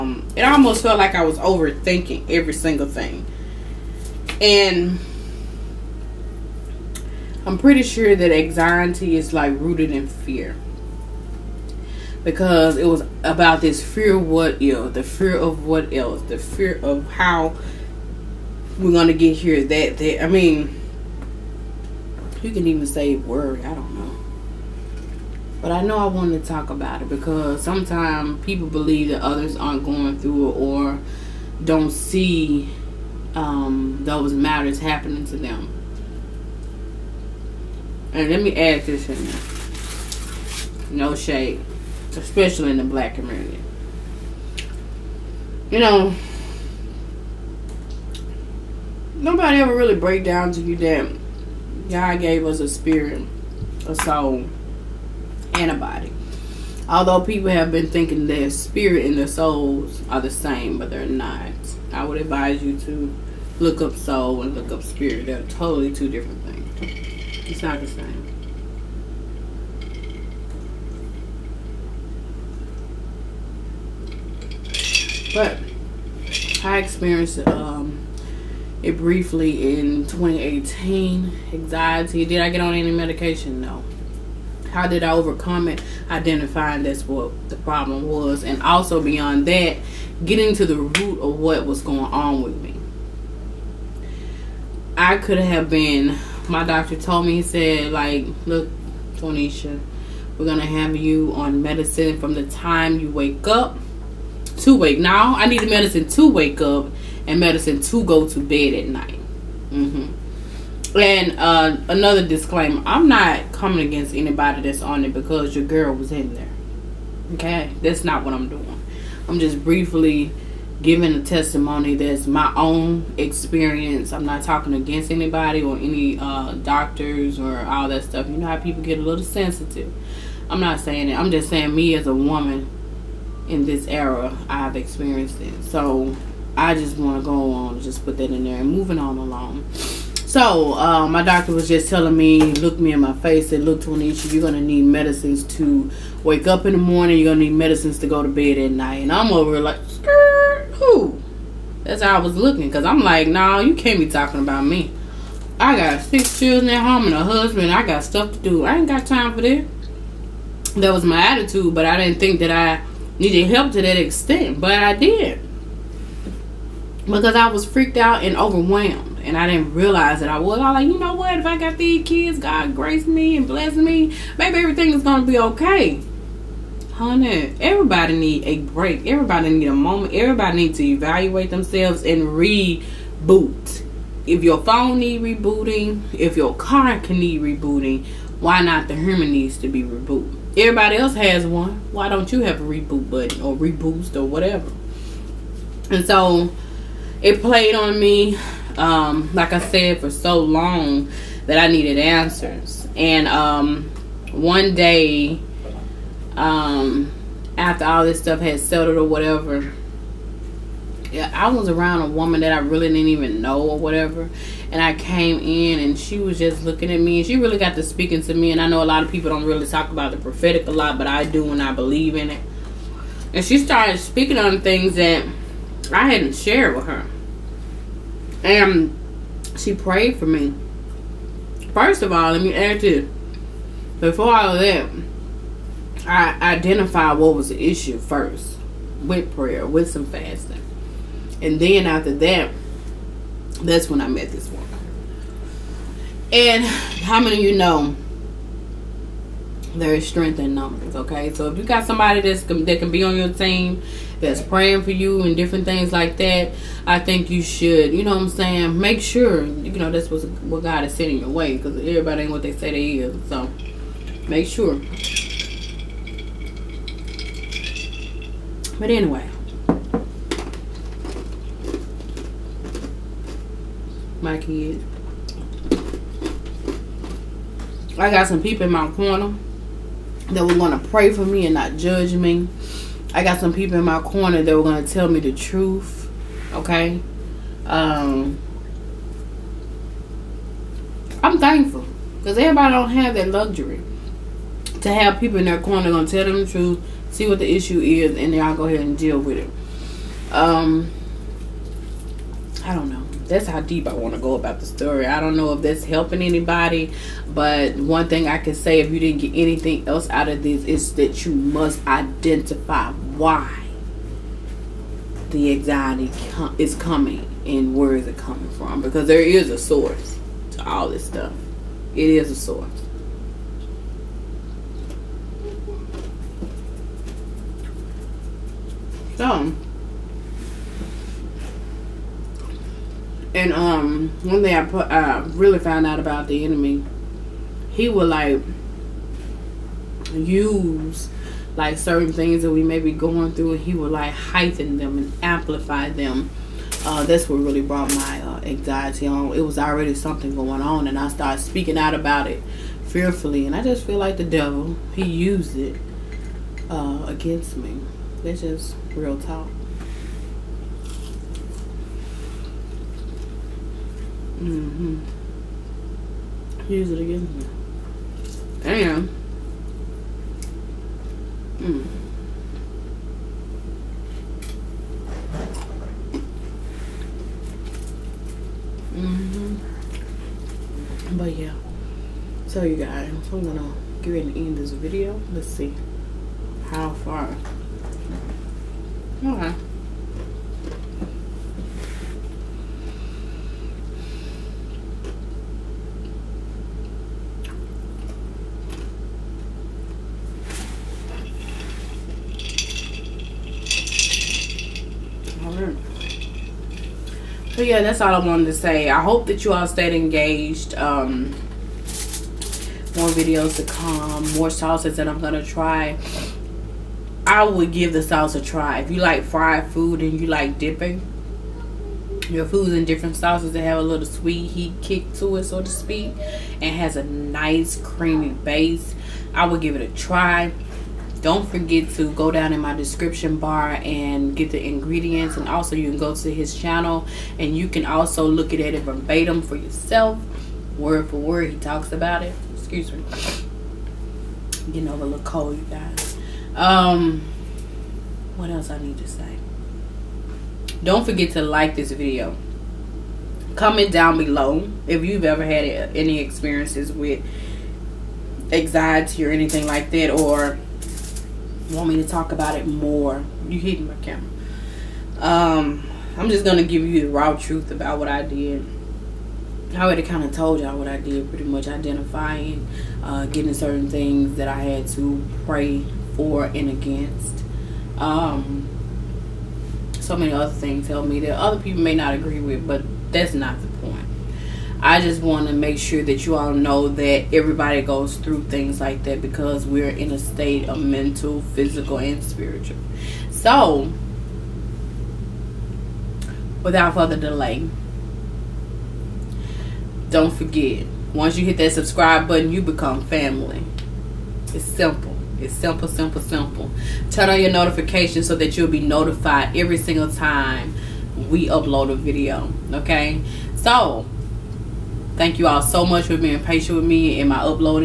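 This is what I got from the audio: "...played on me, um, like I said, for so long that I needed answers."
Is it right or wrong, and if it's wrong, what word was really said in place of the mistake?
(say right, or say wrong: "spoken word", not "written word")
right.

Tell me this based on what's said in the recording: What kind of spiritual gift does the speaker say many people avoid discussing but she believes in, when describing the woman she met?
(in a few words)
the prophetic.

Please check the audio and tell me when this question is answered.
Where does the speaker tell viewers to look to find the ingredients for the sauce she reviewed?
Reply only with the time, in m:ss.
7:12.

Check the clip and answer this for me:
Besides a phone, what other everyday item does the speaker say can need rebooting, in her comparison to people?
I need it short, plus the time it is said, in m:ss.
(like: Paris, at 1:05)
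car, at 3:06.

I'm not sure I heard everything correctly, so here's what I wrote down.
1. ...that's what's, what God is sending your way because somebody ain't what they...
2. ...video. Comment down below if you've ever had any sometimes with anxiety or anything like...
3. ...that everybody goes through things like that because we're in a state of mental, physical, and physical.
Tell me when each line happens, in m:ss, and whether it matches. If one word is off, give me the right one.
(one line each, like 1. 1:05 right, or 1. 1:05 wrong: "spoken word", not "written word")
1. 4:19 wrong: "everybody", not "somebody"
2. 7:31 wrong: "experiences", not "sometimes"
3. 8:06 wrong: "spiritual", not "physical".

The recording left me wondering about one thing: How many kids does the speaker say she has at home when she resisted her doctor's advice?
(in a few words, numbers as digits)
6.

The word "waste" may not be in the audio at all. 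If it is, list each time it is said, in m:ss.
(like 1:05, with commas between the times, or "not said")
not said.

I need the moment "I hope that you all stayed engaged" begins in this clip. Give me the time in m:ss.
6:48.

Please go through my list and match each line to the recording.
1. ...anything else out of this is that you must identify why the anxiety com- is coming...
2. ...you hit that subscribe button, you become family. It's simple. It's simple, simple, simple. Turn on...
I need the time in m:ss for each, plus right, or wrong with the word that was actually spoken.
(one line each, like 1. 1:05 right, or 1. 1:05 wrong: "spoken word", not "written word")
1. 5:09 right
2. 8:21 right.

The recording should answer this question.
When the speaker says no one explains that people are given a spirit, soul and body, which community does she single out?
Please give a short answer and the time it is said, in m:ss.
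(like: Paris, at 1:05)
the black community, at 0:42.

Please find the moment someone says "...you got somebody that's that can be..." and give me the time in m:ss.
4:11.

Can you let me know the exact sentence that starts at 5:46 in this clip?
Uh, that's what really brought my uh, anxiety on.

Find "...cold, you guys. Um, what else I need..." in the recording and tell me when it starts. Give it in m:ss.
7:25.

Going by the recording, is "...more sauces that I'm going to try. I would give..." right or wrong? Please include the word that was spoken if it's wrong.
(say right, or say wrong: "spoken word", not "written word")
right.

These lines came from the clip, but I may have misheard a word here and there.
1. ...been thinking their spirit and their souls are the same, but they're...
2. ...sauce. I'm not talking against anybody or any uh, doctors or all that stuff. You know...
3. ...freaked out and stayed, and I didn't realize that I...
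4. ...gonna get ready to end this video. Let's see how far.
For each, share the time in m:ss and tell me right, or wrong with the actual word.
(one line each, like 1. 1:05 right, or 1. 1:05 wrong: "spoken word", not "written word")
1. 0:57 right
2. 2:03 wrong: "experience", not "sauce"
3. 2:47 wrong: "overwhelmed", not "stayed"
4. 6:23 right.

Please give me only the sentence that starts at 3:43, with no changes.
And she started speaking on things that I hadn't shared with her.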